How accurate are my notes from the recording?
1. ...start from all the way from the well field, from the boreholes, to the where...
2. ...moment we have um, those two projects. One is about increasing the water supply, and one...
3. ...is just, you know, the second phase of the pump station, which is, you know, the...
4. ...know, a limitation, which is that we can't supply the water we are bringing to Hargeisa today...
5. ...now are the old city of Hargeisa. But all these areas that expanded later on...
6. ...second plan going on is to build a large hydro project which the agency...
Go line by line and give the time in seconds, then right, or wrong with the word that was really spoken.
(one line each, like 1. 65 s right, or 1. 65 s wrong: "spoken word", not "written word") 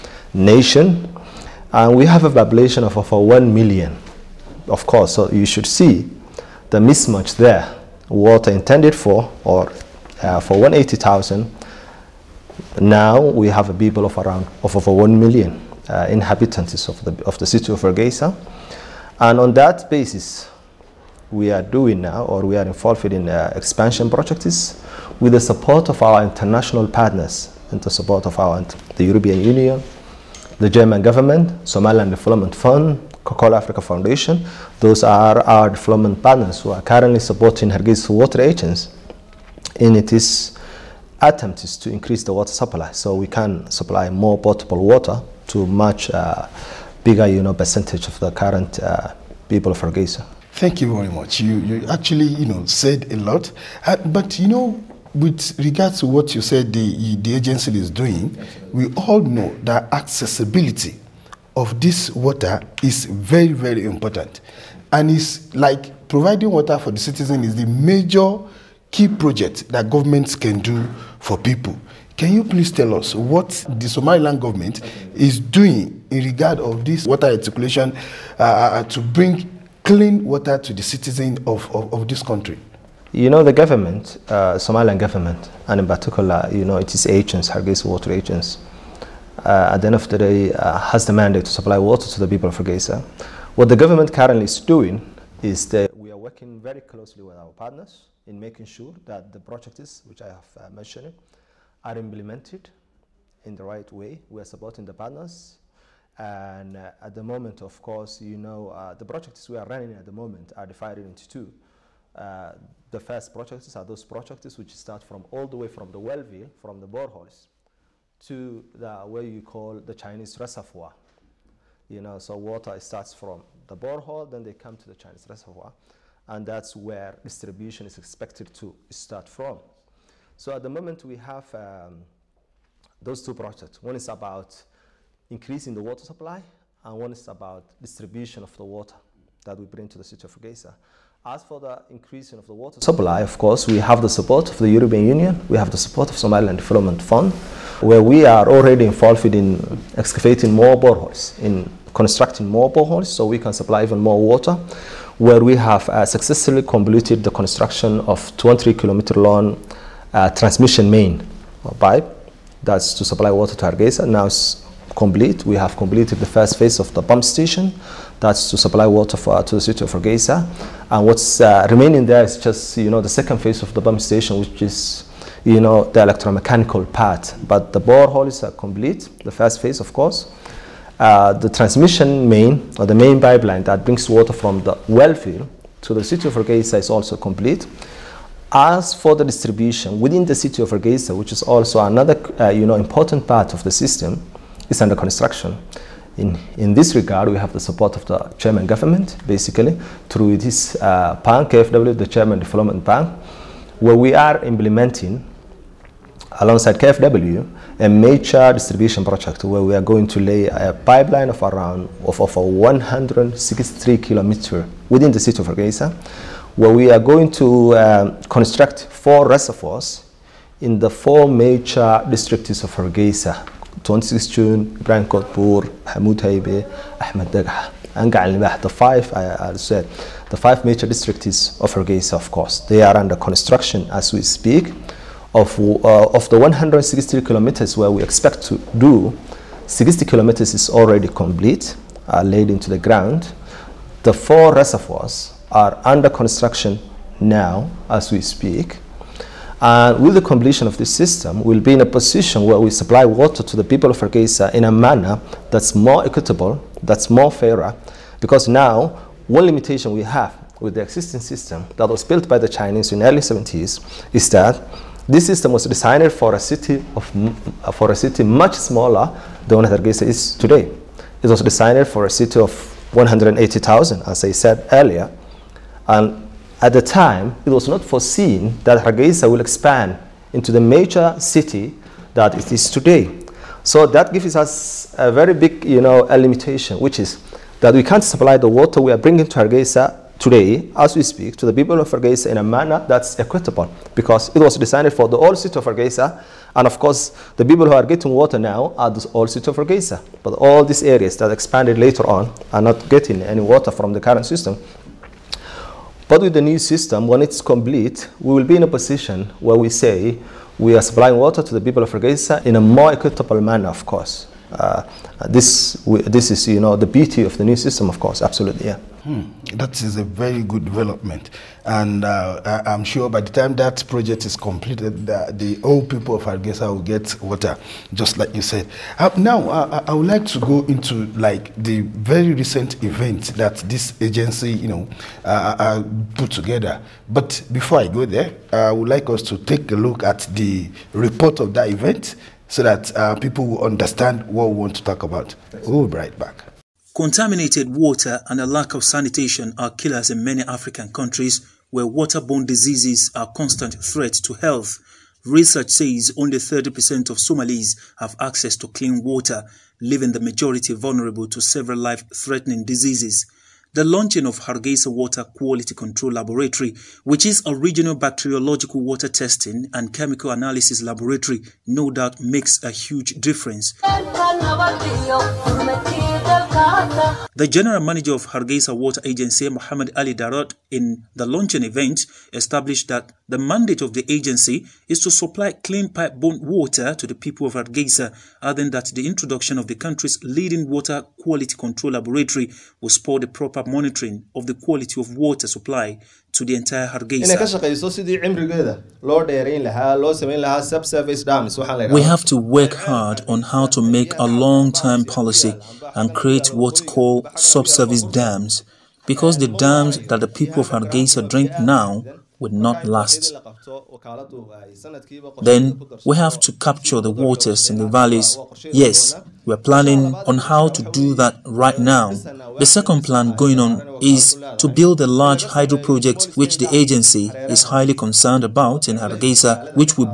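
1. 114 s right
2. 130 s right
3. 172 s right
4. 285 s right
5. 298 s right
6. 422 s right.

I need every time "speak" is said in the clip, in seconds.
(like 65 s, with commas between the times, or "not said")
234 s, 248 s, 291 s.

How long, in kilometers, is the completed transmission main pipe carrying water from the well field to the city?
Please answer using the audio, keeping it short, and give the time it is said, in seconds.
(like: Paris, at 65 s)
23, at 158 s.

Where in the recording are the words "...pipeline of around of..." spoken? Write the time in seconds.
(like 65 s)
210 s.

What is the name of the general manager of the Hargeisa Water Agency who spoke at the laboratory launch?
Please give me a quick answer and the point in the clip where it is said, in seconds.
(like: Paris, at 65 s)
Mohamed Ali Daarood, at 379 s.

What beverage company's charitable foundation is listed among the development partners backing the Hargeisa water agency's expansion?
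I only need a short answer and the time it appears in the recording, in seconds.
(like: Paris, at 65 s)
Coca-Cola Africa Foundation, at 33 s.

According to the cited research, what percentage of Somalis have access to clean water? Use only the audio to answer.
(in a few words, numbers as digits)
30%.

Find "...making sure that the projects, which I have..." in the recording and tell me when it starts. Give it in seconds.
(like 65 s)
98 s.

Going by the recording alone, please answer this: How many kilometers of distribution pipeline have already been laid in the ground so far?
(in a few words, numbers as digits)
60.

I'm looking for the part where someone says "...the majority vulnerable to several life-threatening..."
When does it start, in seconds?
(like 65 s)
360 s.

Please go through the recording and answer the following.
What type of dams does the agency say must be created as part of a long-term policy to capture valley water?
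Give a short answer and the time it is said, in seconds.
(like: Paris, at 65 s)
subsurface dams, at 407 s.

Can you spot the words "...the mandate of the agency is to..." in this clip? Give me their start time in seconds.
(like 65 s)
383 s.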